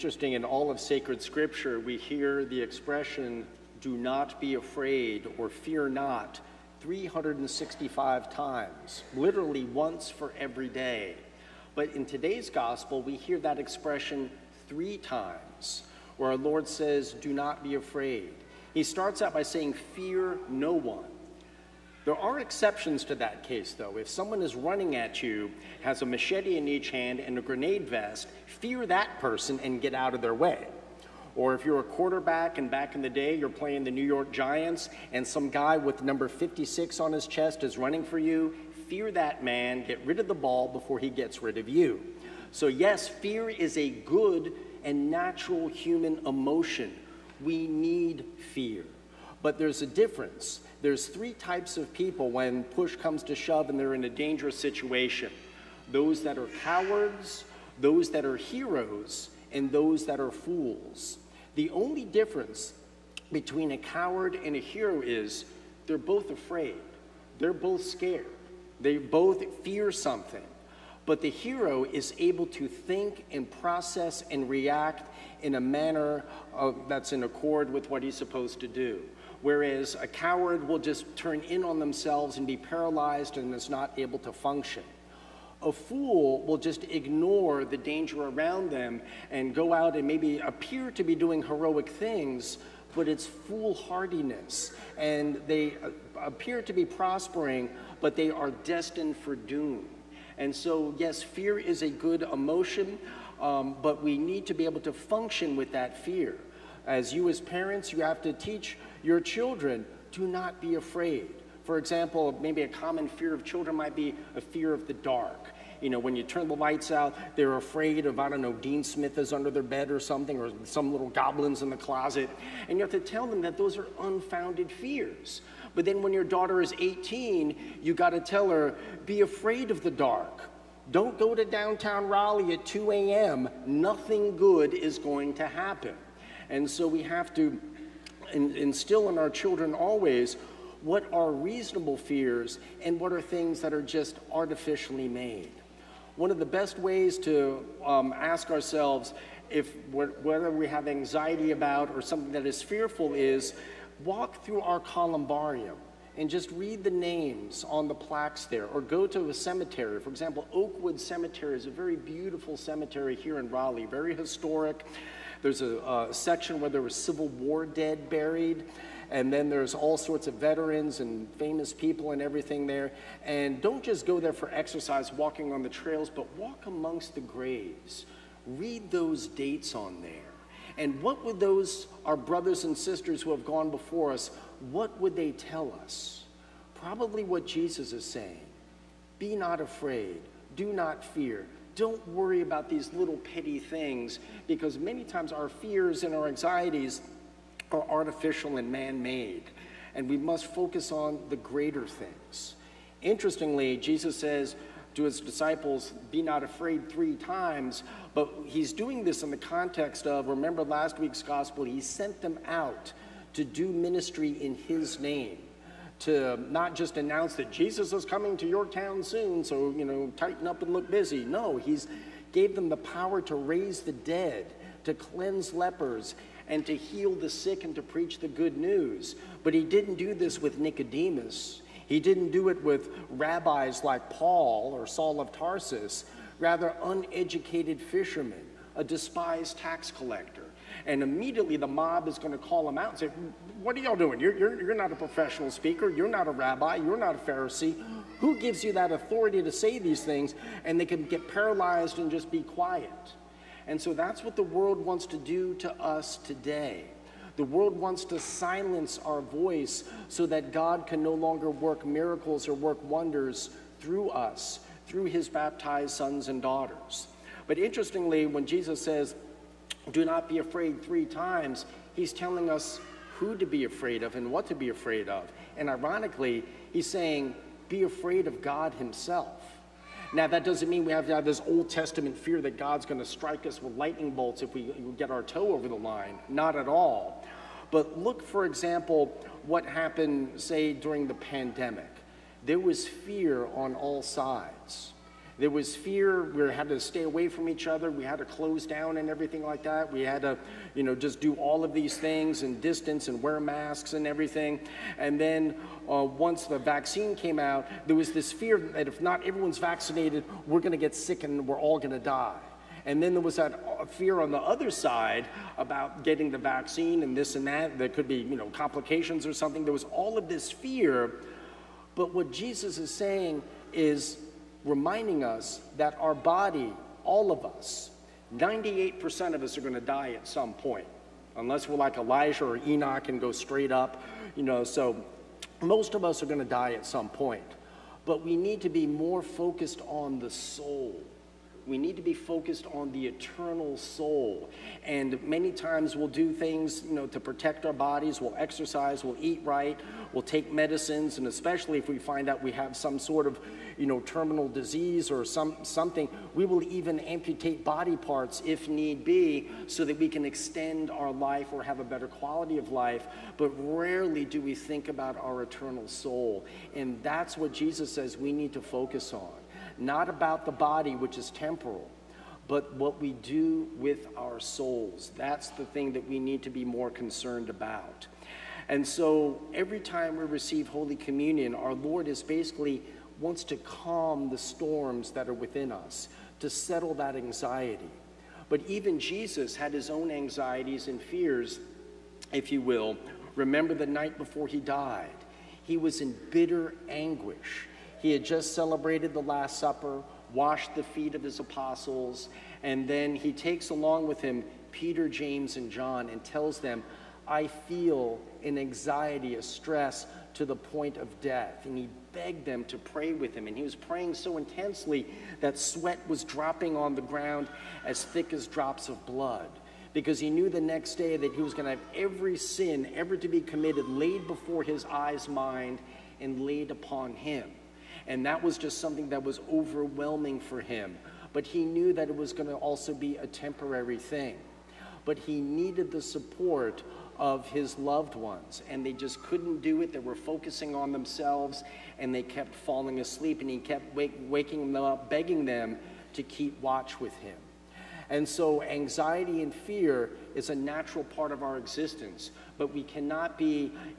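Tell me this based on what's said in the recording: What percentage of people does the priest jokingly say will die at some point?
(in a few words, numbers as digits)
98%.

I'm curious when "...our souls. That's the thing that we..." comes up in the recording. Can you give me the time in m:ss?
6:14.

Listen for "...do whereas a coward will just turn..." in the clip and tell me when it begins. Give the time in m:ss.
1:18.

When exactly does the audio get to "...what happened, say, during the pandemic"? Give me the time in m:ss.
4:49.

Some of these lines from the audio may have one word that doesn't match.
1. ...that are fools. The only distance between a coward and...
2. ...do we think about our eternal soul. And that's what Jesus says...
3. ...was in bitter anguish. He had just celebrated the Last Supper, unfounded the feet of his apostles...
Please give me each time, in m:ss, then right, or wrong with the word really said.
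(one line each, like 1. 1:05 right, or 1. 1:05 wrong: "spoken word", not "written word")
1. 1:00 wrong: "difference", not "distance"
2. 6:04 right
3. 6:35 wrong: "washed", not "unfounded".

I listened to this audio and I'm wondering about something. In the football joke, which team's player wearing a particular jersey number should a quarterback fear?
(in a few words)
New York Giants.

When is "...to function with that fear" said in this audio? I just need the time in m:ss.
1:44.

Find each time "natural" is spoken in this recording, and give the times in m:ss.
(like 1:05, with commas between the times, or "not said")
0:45, 7:30.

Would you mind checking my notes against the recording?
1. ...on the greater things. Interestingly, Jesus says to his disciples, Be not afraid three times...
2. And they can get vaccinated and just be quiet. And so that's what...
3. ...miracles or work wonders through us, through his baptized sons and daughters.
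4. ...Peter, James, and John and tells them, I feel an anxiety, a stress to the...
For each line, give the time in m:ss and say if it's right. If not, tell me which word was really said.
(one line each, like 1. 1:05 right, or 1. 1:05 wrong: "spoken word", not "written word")
1. 3:20 right
2. 4:10 wrong: "paralyzed", not "vaccinated"
3. 4:21 right
4. 6:44 right.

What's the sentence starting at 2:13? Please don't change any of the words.
Nothing good is going to happen.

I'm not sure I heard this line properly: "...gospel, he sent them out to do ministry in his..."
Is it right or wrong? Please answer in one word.
right.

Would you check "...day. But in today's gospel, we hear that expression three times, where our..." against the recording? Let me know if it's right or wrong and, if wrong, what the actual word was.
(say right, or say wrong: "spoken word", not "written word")
right.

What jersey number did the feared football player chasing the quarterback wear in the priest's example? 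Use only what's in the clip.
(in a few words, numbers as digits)
56.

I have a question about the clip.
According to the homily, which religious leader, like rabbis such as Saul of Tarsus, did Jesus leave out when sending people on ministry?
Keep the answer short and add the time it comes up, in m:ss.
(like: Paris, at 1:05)
Nicodemus, at 3:50.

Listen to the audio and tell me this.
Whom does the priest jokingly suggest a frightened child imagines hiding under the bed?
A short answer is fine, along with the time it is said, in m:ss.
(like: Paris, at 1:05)
Dean Smith, at 1:58.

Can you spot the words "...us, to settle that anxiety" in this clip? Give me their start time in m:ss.
6:25.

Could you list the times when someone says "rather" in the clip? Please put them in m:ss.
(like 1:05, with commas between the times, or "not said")
3:56.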